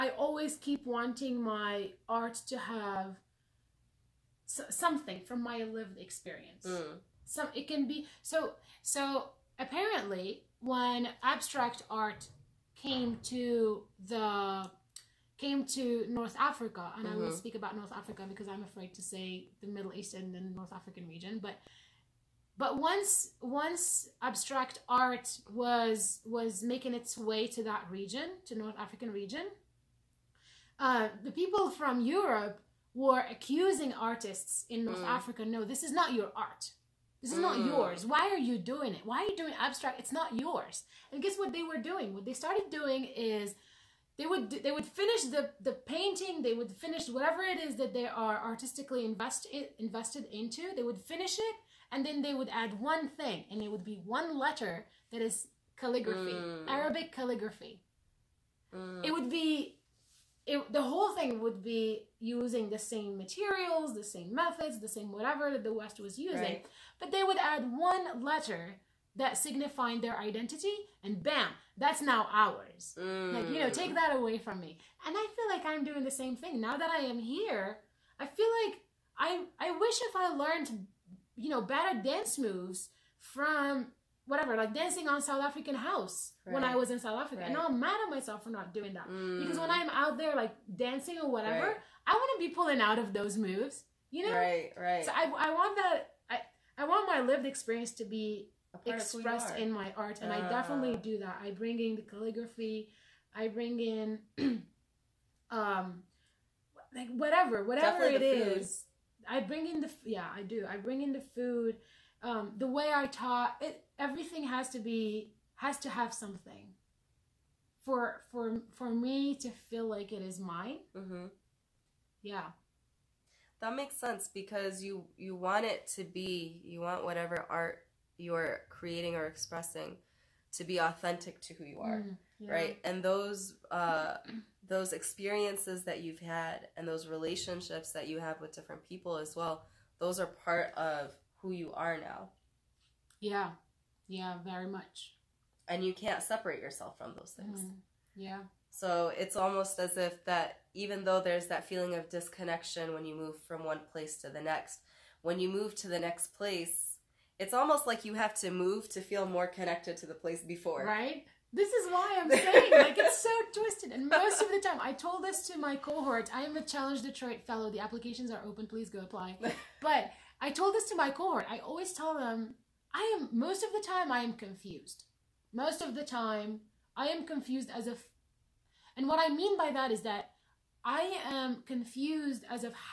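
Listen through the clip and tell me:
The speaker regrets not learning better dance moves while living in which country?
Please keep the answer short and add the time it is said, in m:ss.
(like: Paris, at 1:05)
South Africa, at 1:26.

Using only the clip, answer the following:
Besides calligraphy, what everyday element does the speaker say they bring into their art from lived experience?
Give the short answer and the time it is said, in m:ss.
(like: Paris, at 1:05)
Food, at 1:51.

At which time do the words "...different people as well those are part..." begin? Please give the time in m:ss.
2:18.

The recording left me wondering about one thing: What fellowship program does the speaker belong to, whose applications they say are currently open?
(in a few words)
Challenge Detroit.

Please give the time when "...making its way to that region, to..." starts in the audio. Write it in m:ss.
0:26.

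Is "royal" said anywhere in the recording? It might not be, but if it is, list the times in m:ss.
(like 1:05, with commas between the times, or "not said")
not said.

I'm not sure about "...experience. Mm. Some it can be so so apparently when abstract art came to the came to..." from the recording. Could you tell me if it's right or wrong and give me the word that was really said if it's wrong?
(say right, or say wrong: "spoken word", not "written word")
right.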